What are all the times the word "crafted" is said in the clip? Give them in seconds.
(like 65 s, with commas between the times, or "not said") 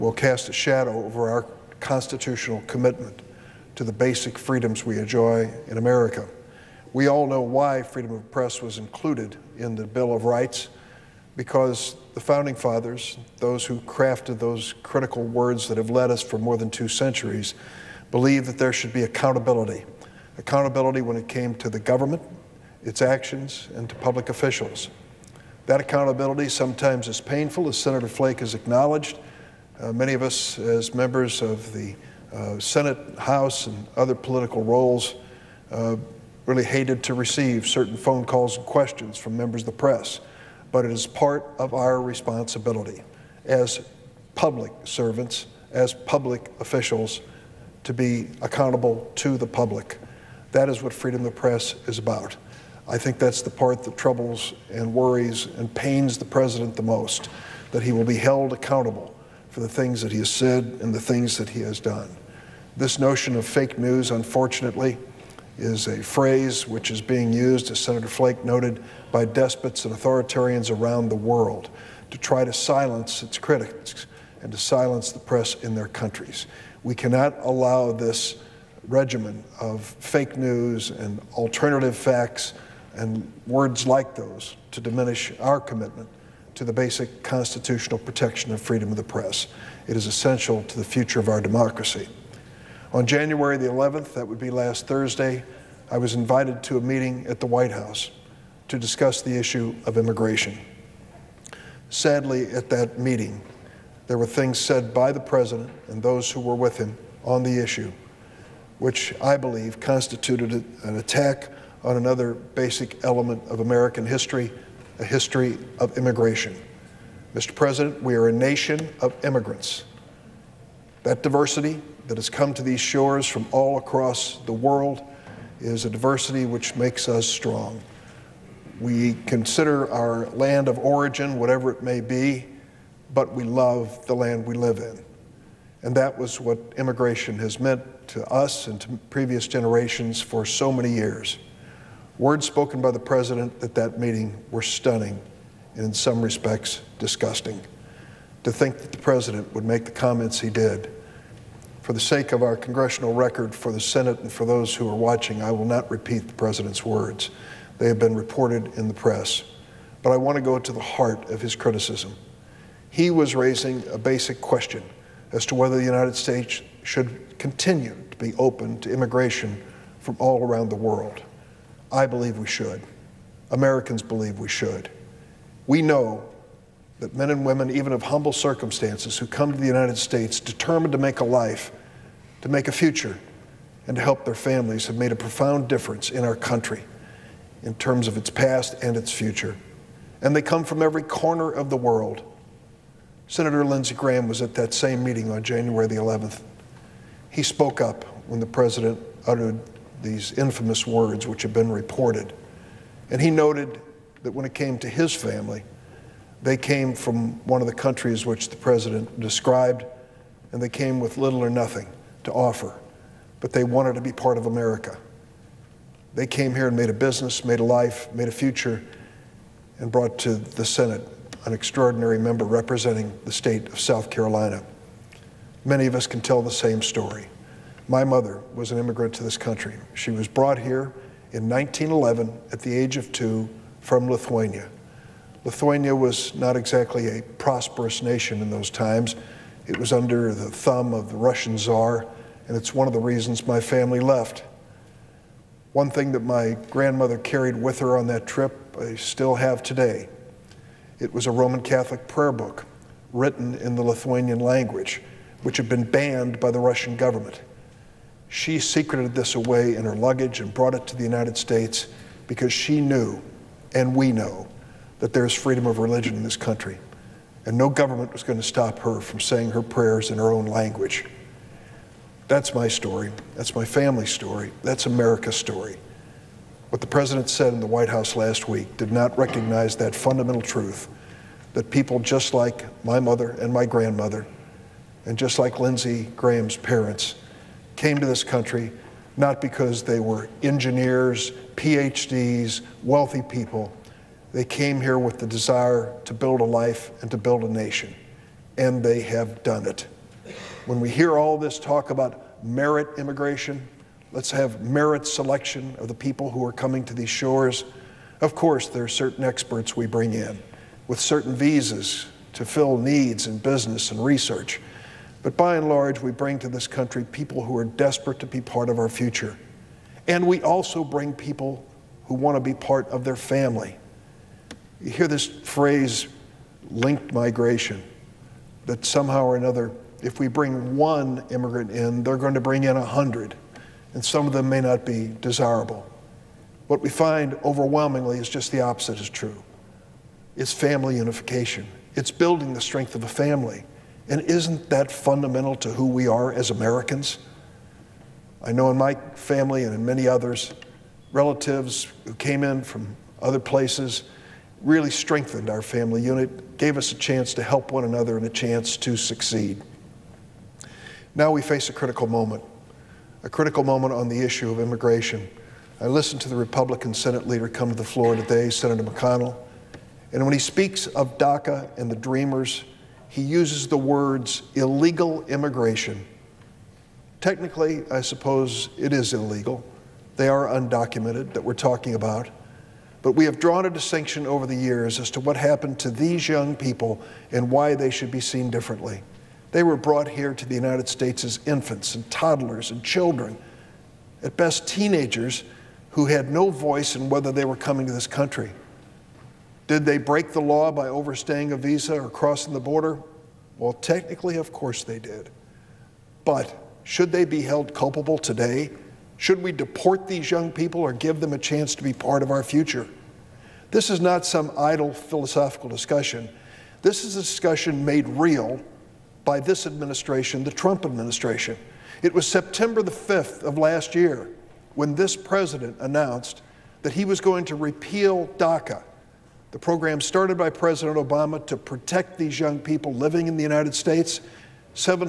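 13 s.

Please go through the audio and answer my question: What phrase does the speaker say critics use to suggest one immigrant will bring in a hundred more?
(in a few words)
linked migration.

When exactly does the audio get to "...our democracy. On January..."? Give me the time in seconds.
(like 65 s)
91 s.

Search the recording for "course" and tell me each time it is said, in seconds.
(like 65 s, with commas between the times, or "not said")
308 s, 404 s.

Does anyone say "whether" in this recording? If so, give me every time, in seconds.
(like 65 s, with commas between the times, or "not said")
165 s, 397 s.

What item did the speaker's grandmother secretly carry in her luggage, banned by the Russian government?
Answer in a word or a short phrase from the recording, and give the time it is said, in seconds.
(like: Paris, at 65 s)
Roman Catholic prayer book, at 251 s.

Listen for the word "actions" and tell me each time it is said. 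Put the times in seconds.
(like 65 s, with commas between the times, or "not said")
23 s.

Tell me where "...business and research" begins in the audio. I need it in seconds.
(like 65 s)
313 s.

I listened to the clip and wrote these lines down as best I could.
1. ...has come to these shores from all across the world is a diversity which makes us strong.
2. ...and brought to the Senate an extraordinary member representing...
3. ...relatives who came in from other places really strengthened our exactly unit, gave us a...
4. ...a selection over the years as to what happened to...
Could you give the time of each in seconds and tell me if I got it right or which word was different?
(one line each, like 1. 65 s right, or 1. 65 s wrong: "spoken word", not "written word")
1. 122 s right
2. 219 s right
3. 351 s wrong: "family", not "exactly"
4. 383 s wrong: "distinction", not "selection".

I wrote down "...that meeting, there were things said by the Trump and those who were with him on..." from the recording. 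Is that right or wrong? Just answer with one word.
wrong.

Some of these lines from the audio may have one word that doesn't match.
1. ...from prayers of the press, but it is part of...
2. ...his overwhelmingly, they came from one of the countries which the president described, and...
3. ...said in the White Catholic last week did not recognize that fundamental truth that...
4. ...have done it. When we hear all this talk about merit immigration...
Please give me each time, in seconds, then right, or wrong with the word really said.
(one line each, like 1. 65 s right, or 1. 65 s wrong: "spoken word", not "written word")
1. 39 s wrong: "members", not "prayers"
2. 204 s wrong: "family", not "overwhelmingly"
3. 277 s wrong: "House", not "Catholic"
4. 299 s right.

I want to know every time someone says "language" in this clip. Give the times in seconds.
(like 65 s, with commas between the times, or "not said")
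254 s, 270 s.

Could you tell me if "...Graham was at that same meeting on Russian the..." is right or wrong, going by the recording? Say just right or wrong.
wrong.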